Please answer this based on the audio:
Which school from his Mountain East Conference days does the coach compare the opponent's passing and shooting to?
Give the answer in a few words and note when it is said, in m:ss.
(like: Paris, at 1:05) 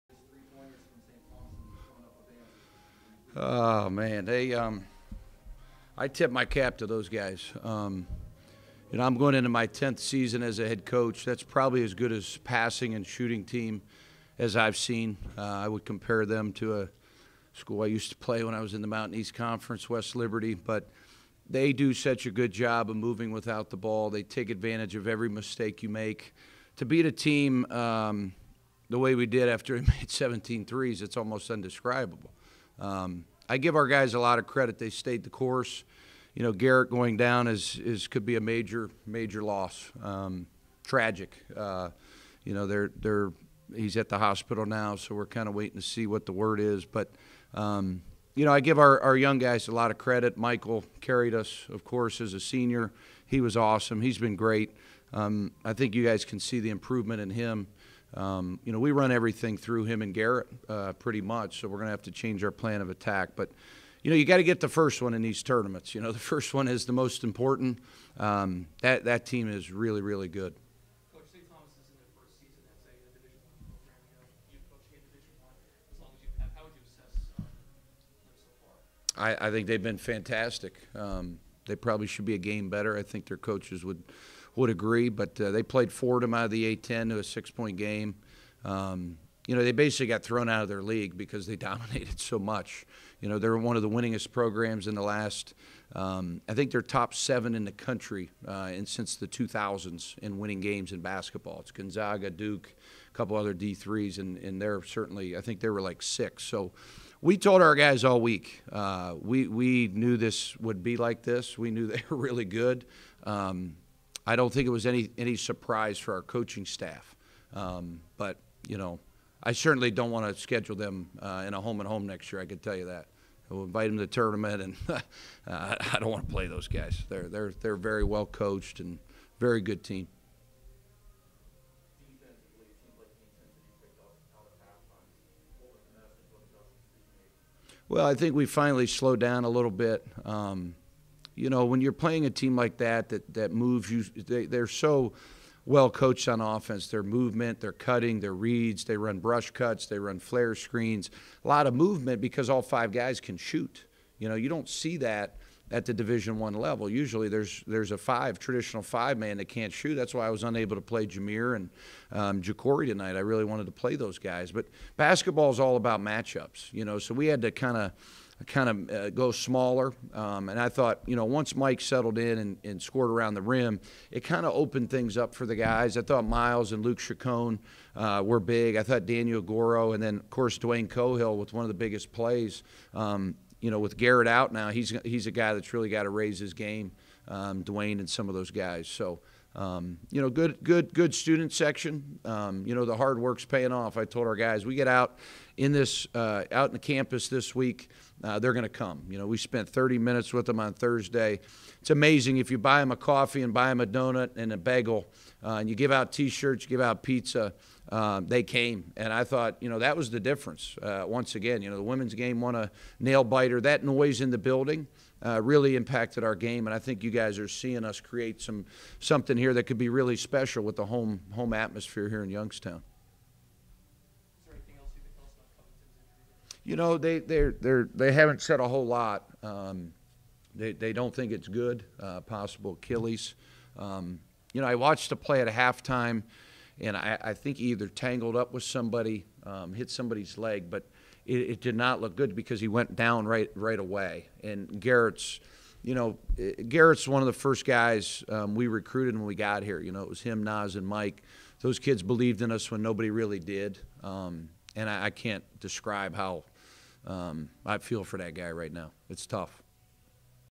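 West Liberty, at 0:19.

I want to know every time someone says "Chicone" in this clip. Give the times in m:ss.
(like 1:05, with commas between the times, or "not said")
2:56.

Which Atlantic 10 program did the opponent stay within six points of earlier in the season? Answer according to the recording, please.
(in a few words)
Fordham.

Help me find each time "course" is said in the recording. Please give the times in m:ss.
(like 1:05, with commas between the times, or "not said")
0:35, 0:51, 3:00.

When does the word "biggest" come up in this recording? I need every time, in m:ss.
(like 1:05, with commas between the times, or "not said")
3:01.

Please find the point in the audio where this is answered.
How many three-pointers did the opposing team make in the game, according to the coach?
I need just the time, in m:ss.
0:30.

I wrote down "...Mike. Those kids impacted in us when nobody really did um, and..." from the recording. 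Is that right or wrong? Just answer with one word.
wrong.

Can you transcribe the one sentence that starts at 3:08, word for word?
So, um, you know, good, good, good student section.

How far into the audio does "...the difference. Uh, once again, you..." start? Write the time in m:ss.
3:30.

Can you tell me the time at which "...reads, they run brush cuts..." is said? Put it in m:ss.
2:28.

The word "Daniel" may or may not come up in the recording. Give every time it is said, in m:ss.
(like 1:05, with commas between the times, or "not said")
2:59.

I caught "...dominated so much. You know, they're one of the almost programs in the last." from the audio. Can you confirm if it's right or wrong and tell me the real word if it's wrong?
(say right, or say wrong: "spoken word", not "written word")
wrong: "winningest", not "almost".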